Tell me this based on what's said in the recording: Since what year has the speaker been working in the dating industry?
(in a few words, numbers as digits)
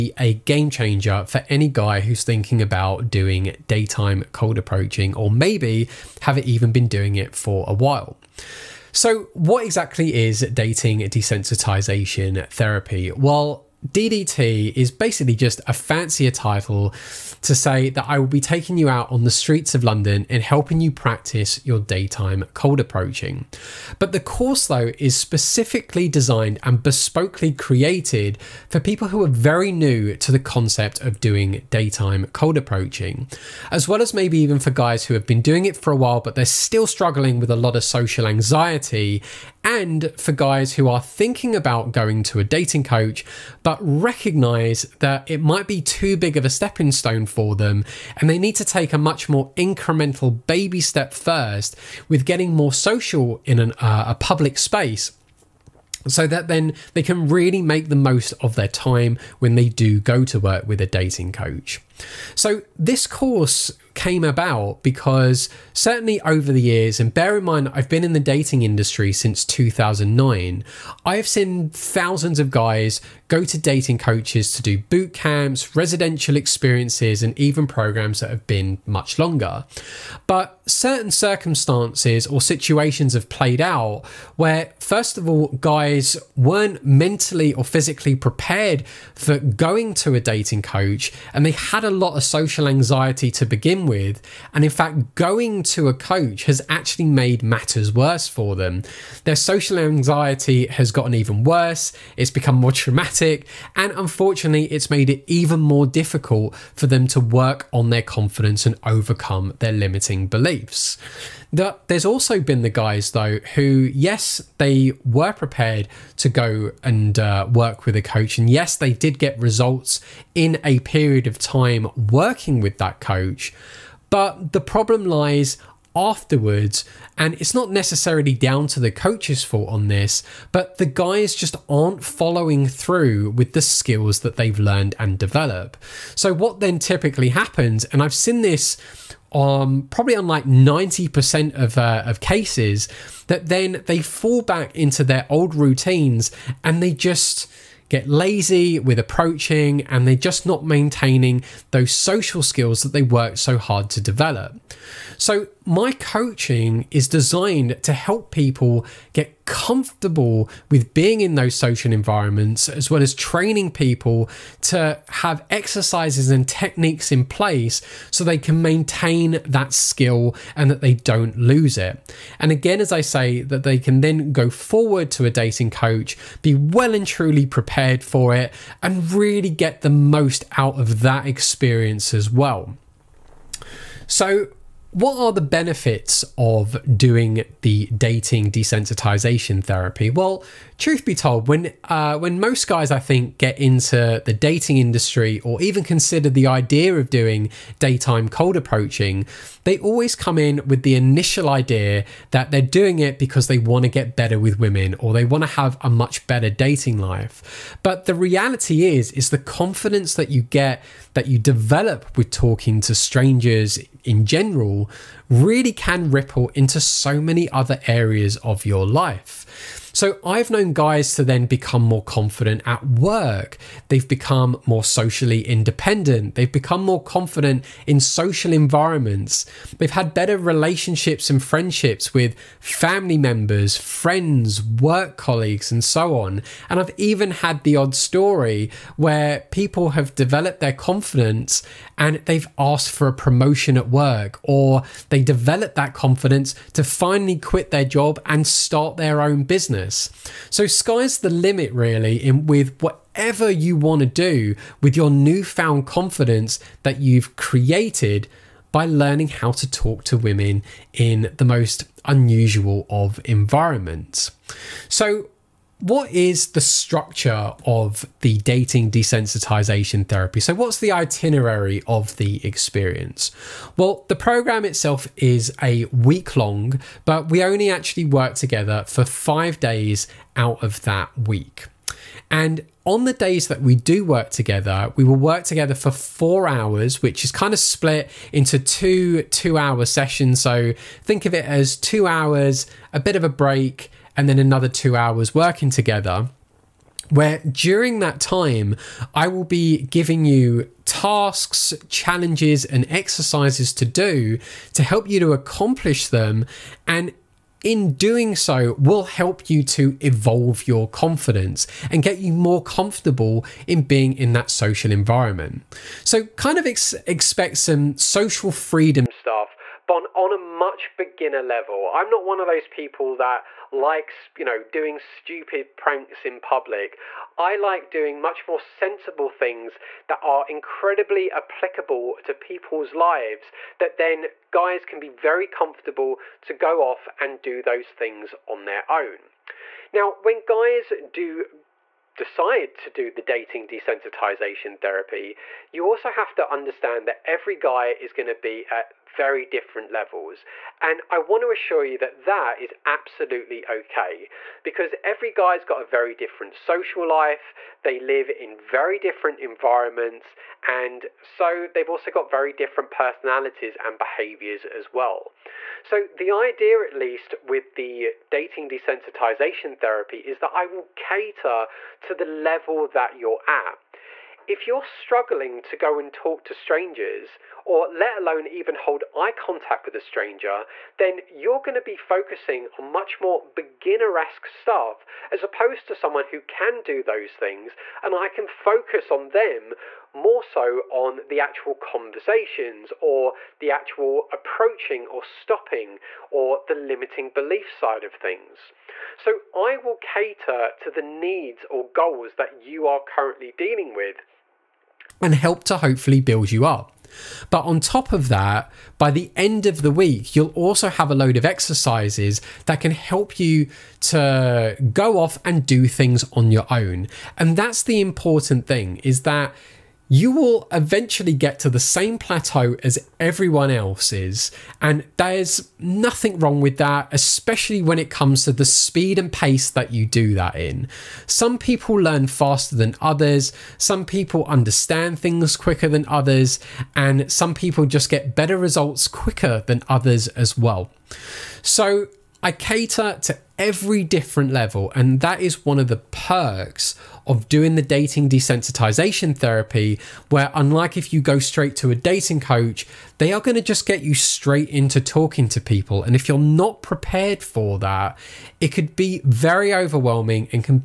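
2009.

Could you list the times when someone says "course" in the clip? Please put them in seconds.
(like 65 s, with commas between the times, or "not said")
24 s, 63 s.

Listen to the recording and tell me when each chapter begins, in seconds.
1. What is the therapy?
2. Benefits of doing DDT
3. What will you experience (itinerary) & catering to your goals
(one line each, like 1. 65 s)
1. 9 s
2. 183 s
3. 265 s.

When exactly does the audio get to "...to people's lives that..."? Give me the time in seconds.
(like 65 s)
332 s.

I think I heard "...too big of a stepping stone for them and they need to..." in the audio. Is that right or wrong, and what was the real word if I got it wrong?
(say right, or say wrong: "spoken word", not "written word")
right.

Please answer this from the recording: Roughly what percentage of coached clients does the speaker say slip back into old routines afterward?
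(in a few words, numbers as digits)
90%.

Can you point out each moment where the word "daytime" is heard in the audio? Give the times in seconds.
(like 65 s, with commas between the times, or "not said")
3 s, 21 s, 31 s, 197 s.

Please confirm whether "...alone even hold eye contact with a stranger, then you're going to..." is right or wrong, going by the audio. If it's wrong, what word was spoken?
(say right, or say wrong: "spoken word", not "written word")
right.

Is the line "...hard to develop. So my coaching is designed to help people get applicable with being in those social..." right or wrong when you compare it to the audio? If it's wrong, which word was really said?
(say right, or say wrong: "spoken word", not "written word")
wrong: "comfortable", not "applicable".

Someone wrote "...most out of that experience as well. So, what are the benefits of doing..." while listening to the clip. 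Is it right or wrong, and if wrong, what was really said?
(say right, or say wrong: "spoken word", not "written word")
right.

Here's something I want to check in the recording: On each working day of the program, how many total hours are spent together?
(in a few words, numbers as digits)
4.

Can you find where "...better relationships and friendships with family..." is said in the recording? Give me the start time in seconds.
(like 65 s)
230 s.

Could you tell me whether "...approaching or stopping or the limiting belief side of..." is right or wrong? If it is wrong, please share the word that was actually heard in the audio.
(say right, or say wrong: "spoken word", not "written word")
right.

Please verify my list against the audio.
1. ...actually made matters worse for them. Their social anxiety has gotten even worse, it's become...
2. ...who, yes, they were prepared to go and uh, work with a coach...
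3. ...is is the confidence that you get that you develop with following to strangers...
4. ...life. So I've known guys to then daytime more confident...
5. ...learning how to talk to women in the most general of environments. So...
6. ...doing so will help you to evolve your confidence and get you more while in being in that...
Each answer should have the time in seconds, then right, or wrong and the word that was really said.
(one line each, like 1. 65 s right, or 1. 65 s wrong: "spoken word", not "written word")
1. 96 s right
2. 113 s right
3. 208 s wrong: "talking", not "following"
4. 218 s wrong: "become", not "daytime"
5. 258 s wrong: "unusual", not "general"
6. 307 s wrong: "comfortable", not "while".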